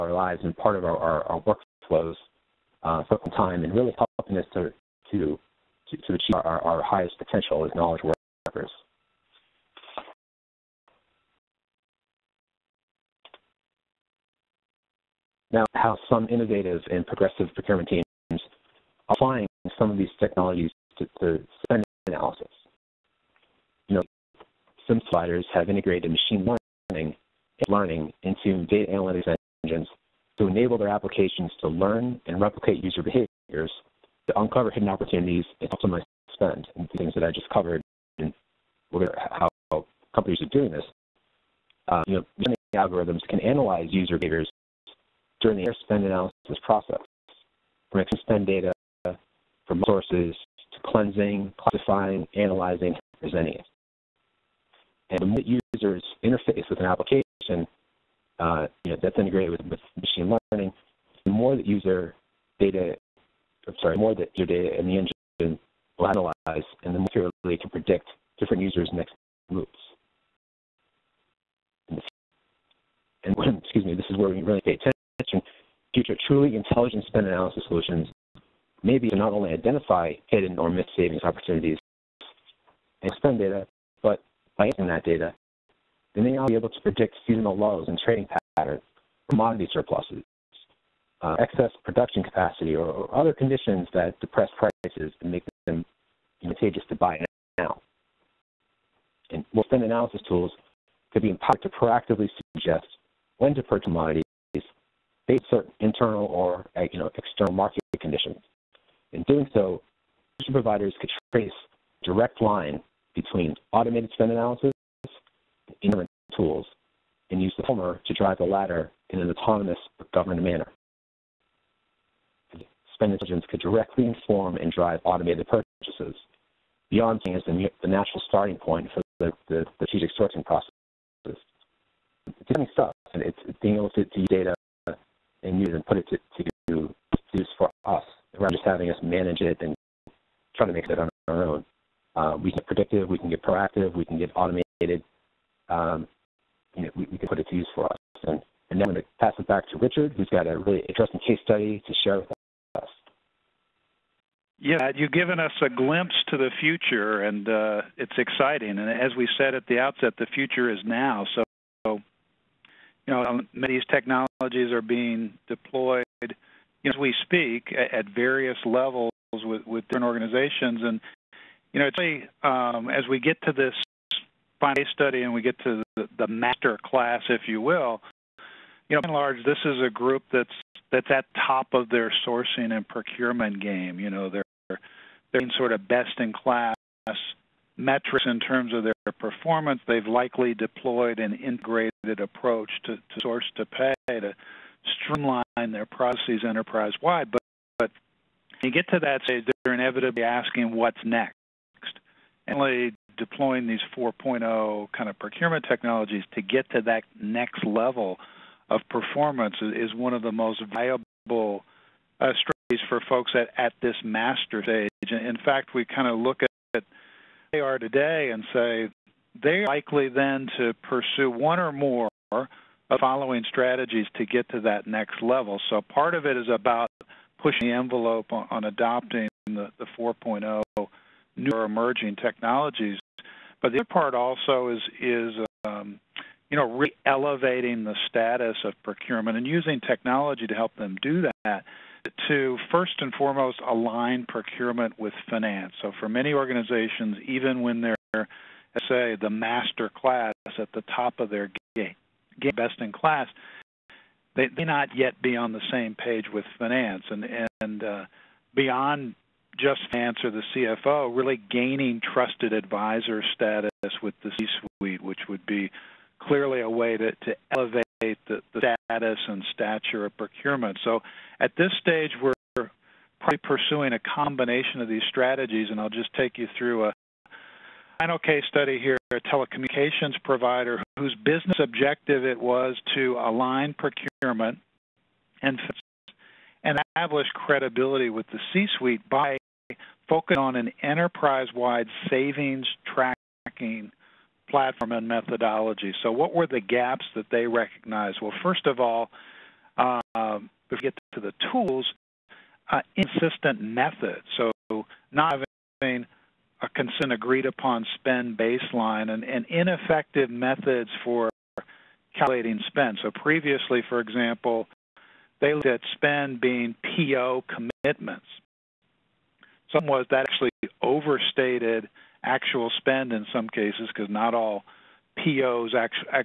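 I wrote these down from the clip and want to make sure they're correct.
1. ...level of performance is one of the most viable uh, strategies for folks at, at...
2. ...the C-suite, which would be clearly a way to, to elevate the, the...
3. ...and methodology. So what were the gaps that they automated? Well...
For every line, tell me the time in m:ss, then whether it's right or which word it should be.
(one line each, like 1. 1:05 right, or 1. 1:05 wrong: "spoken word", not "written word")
1. 3:27 right
2. 4:24 right
3. 4:54 wrong: "recognized", not "automated".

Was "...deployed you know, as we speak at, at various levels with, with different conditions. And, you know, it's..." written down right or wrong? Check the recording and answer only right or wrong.
wrong.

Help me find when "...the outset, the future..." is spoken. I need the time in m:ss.
2:39.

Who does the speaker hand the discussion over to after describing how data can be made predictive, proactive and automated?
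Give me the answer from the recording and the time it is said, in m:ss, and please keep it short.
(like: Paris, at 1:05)
Richard, at 2:29.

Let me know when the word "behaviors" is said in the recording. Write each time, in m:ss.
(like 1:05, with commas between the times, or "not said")
0:33, 0:44.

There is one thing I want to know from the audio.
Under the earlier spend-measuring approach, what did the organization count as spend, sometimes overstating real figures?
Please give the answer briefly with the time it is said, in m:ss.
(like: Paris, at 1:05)
PO commitments, at 5:16.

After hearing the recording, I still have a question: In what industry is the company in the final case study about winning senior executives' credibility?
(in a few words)
telecommunications provider.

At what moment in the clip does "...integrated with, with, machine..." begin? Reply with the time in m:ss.
0:59.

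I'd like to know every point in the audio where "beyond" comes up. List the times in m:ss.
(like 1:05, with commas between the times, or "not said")
2:06, 4:18.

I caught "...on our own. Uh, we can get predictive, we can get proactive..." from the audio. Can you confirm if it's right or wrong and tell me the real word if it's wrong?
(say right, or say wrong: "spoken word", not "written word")
right.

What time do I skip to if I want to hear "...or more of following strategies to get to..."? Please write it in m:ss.
3:41.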